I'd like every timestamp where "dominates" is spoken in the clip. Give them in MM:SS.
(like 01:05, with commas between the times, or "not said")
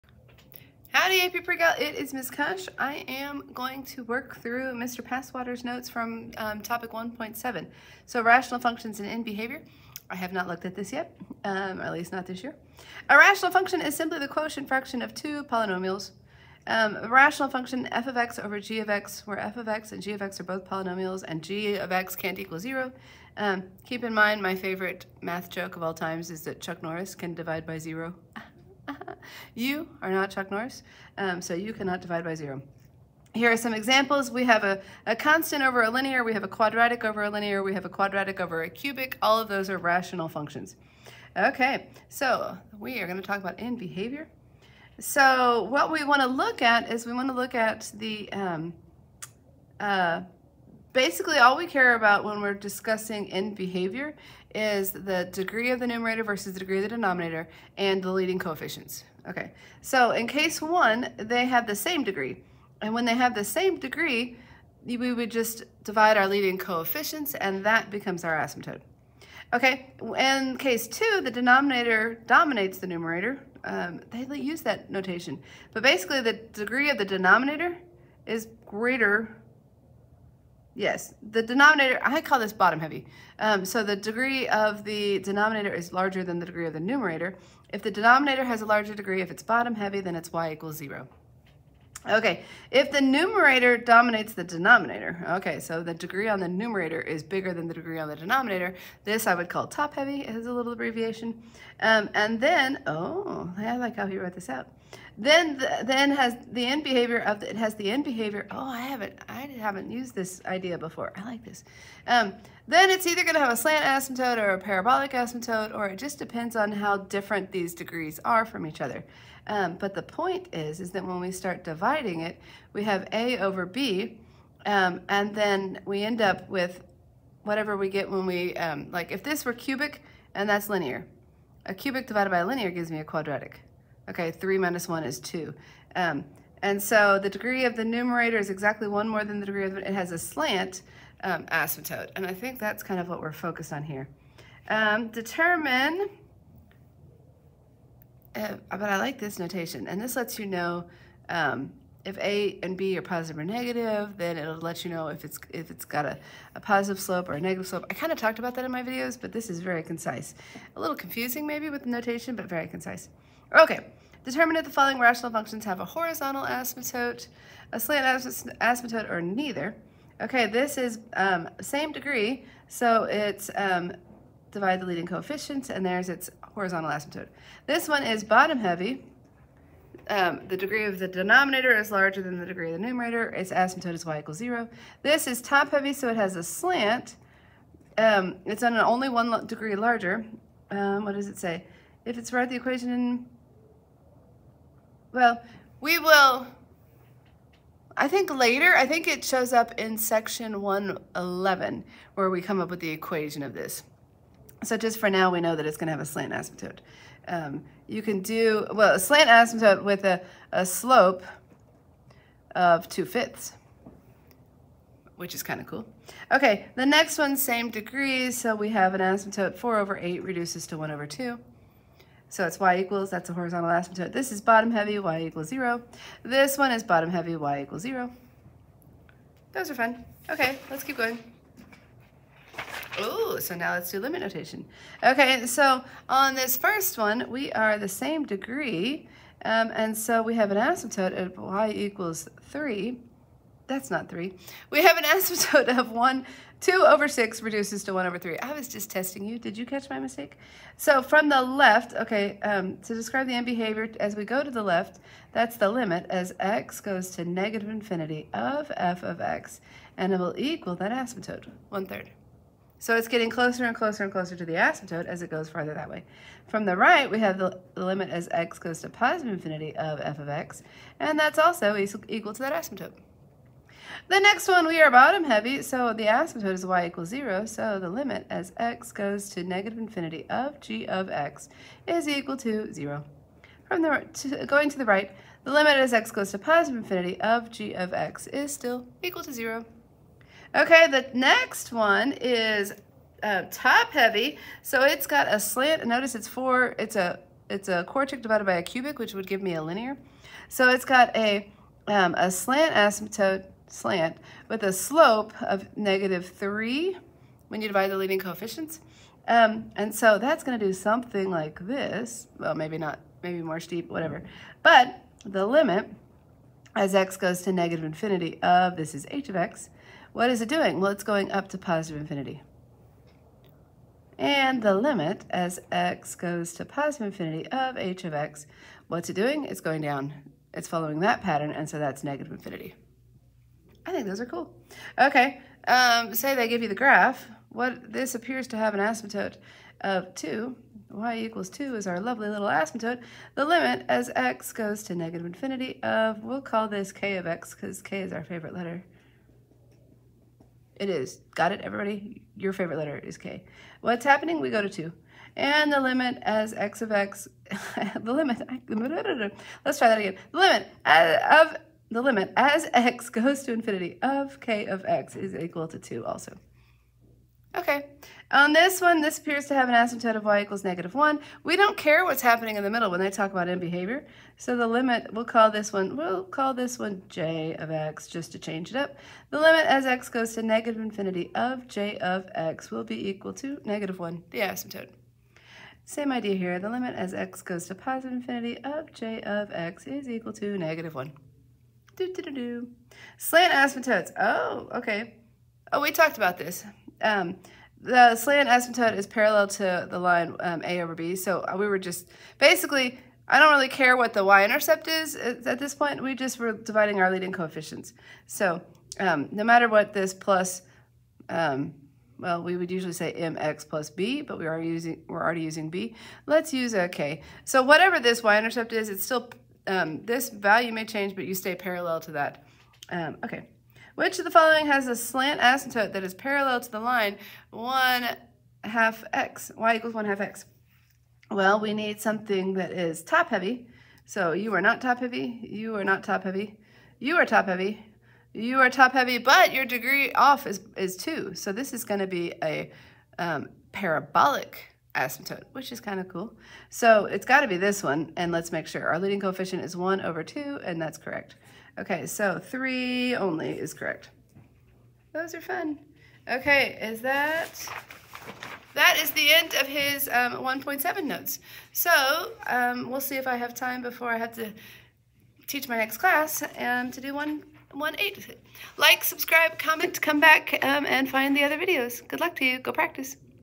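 01:12, 01:33.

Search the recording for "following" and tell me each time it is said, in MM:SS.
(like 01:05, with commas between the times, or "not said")
02:44, 05:30, 07:04.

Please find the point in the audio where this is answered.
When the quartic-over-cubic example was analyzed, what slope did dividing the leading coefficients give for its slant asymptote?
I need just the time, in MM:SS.
05:05.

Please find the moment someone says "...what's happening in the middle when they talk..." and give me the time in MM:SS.
06:12.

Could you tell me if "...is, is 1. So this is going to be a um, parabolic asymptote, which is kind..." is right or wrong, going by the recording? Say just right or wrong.
wrong.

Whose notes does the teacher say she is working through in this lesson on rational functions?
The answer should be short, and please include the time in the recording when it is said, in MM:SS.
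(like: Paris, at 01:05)
Mr. Passwater, at 00:04.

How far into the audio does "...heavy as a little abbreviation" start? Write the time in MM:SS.
01:39.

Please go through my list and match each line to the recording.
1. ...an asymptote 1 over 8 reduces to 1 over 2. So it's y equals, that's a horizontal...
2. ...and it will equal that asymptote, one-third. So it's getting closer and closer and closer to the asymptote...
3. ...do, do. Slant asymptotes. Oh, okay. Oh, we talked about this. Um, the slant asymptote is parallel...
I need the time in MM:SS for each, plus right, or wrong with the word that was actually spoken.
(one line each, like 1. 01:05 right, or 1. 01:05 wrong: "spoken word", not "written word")
1. 03:38 wrong: "4", not "1"
2. 04:19 right
3. 06:32 right.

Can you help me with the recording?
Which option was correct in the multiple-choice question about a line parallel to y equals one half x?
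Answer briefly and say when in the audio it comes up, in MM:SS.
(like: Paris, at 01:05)
3 only, at 07:32.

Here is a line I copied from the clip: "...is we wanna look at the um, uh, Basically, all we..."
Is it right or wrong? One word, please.
right.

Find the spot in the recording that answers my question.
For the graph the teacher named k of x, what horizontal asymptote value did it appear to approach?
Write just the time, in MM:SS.
05:40.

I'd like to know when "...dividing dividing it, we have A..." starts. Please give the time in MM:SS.
02:01.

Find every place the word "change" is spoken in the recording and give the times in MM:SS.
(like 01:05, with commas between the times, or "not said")
06:18, 07:00.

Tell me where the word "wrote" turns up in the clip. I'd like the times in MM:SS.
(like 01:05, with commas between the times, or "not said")
01:44.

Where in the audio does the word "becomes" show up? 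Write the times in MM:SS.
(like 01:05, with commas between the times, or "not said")
01:07.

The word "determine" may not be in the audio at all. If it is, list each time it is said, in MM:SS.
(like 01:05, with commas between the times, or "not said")
02:25, 02:44.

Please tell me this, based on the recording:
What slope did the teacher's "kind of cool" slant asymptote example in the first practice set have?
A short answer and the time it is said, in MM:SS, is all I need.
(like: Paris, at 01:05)
2/5, at 03:32.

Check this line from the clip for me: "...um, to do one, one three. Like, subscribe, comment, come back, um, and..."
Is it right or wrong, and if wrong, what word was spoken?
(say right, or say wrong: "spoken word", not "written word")
wrong: "eight", not "three".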